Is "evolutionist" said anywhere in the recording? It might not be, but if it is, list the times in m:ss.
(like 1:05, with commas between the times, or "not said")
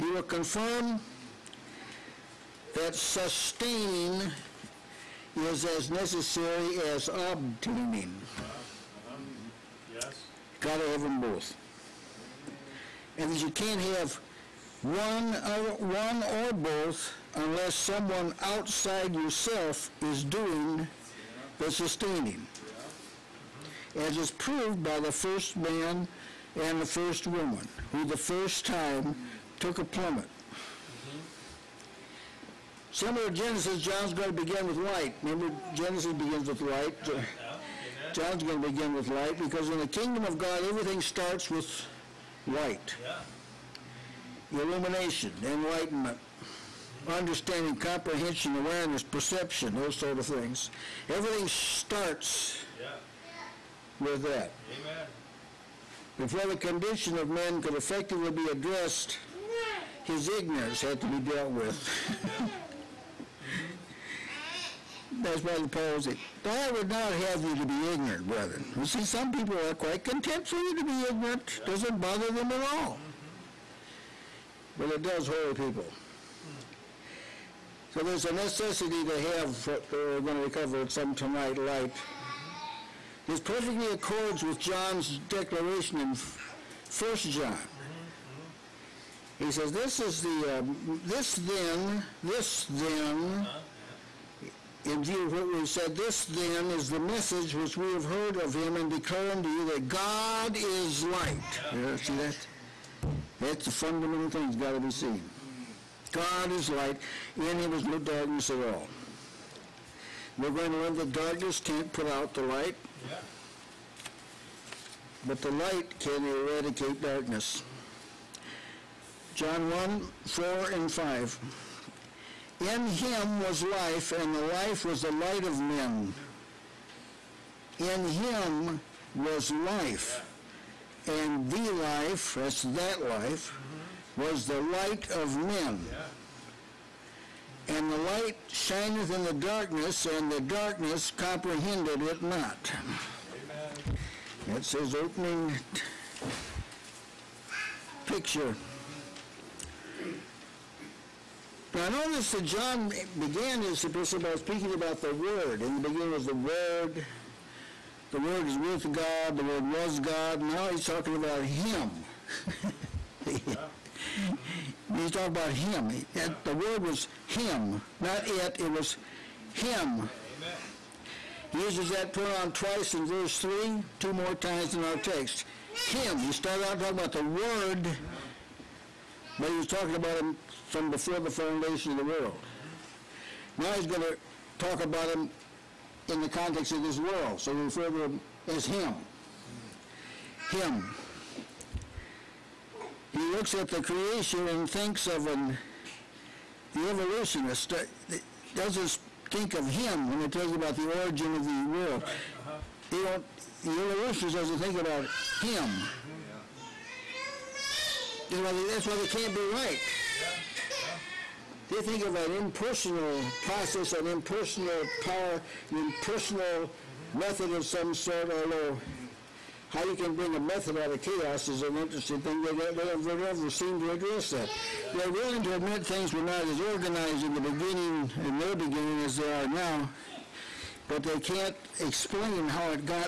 3:16, 3:23.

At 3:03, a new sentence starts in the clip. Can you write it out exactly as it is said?
Now he's going to talk about him in the context of this world, so we refer to him as Him.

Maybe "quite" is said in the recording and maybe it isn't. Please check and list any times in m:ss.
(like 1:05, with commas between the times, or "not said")
1:09.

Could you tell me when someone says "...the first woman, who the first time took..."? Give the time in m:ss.
0:26.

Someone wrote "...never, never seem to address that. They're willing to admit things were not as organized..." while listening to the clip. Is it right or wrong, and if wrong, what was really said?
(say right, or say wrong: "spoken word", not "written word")
right.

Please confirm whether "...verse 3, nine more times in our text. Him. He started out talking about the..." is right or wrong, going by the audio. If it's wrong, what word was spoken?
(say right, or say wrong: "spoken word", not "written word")
wrong: "two", not "nine".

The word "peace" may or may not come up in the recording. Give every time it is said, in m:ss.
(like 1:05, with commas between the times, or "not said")
not said.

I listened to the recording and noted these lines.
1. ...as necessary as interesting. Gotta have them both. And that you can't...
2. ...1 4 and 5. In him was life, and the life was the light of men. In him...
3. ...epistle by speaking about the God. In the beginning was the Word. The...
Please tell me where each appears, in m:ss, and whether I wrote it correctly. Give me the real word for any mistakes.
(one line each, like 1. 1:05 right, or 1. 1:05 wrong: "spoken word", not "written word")
1. 0:05 wrong: "obtaining", not "interesting"
2. 1:59 right
3. 2:33 wrong: "Word", not "God".